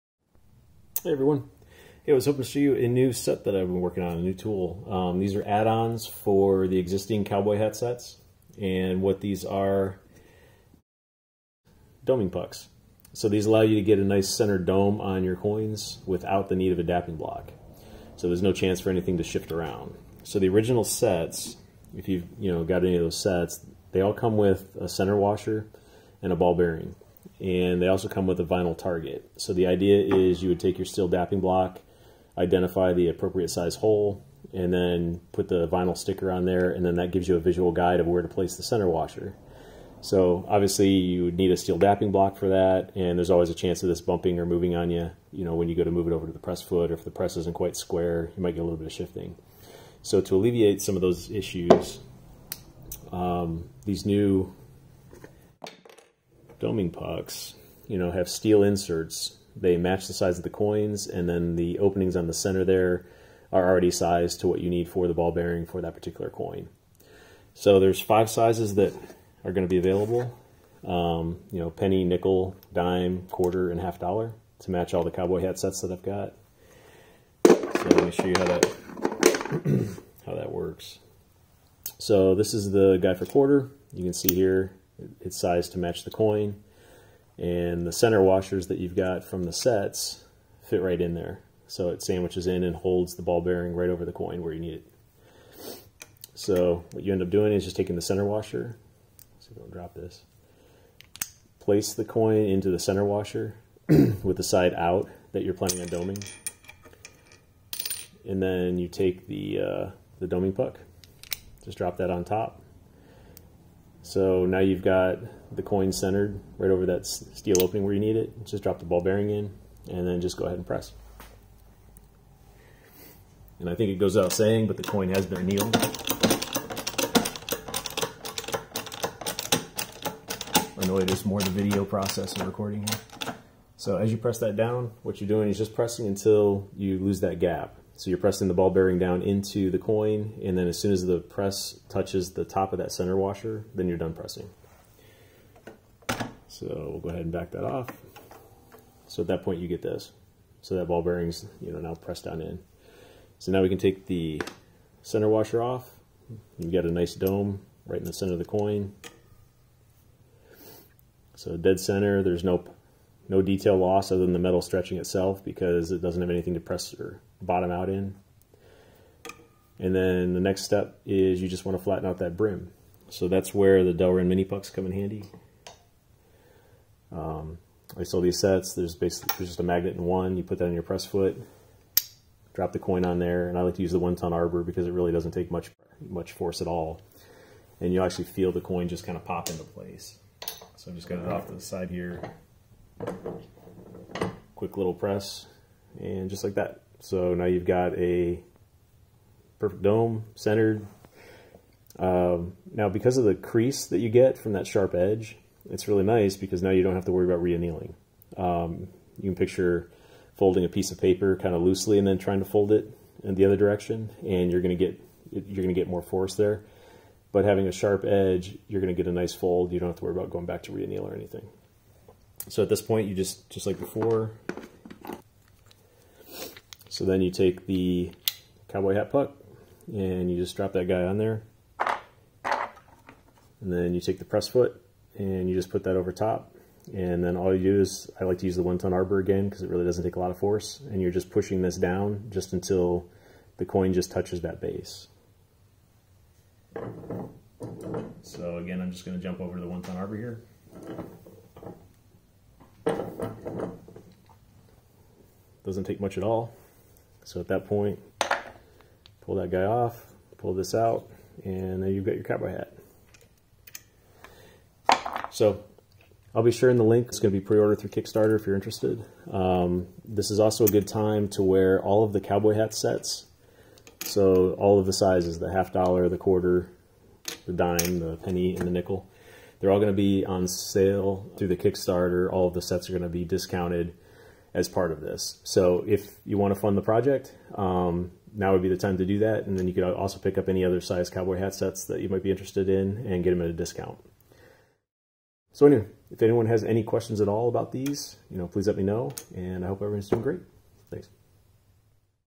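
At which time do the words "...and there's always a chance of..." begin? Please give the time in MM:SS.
00:42.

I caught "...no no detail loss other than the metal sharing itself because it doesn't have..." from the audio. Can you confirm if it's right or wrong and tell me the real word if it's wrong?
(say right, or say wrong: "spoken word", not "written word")
wrong: "stretching", not "sharing".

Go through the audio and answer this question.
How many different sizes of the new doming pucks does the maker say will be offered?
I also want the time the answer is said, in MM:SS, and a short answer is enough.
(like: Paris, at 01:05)
5, at 01:07.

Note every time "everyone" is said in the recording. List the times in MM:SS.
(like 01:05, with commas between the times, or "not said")
00:01, 04:59.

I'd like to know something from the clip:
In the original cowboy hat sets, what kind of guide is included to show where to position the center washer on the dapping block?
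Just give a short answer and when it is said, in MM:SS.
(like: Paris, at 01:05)
vinyl target, at 00:28.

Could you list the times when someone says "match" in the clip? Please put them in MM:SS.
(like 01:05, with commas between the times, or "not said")
00:59, 01:14, 01:25.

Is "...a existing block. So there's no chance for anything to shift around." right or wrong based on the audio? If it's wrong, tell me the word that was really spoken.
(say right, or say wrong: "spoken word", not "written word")
wrong: "dapping", not "existing".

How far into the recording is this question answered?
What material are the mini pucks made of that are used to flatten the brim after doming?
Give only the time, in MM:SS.
02:53.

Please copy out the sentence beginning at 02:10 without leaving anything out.
Annoyed us more the video process and recording here.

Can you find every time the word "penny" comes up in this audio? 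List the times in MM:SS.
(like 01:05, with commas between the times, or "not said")
01:11, 04:38.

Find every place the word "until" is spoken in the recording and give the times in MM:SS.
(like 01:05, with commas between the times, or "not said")
02:16, 04:02.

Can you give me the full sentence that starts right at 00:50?
So to alleviate some of those issues, um, these new doming pucks, you know, have steel inserts.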